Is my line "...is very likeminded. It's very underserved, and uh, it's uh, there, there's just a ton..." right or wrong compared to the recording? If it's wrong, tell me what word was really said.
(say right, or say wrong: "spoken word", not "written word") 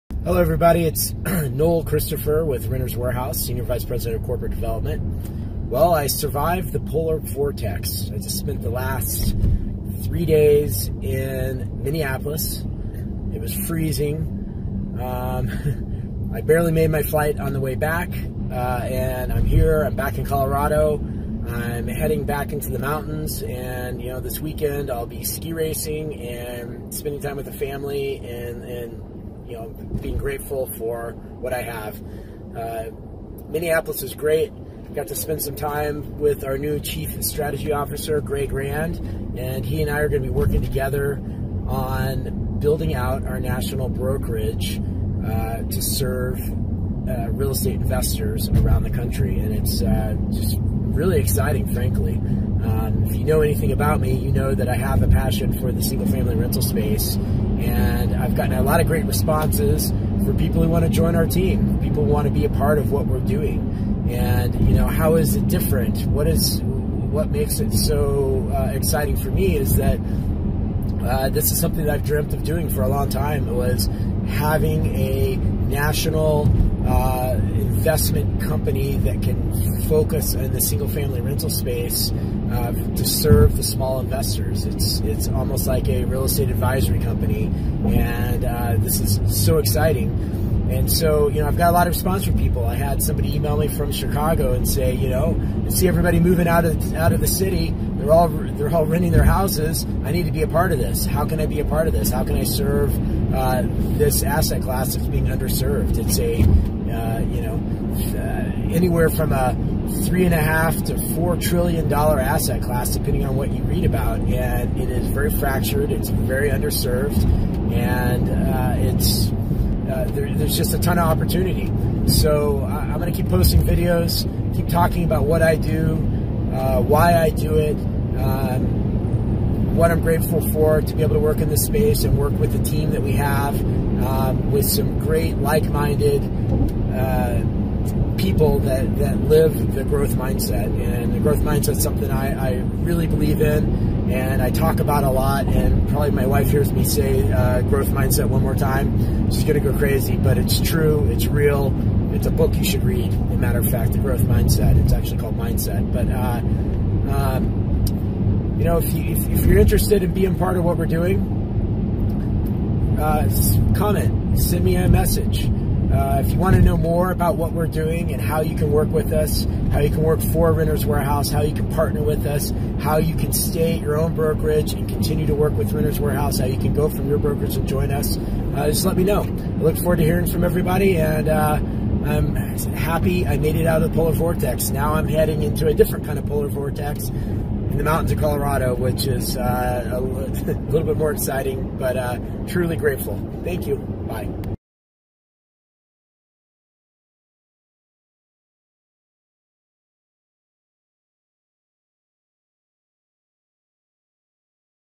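wrong: "fractured", not "likeminded".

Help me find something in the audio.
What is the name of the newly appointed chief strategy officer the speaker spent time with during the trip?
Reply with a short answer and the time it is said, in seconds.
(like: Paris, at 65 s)
Greg Rand, at 38 s.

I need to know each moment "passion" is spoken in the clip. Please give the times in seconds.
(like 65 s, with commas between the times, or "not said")
55 s.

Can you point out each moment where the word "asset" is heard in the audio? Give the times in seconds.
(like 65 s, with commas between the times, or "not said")
104 s, 112 s.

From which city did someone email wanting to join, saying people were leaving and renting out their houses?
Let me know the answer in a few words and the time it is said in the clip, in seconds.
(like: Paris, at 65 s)
Chicago, at 93 s.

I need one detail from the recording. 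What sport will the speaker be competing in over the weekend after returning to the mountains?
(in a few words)
ski racing.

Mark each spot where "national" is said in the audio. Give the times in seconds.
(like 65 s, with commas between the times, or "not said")
43 s, 75 s.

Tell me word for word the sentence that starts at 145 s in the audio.
And probably my wife hears me say uh, growth mindset one more time.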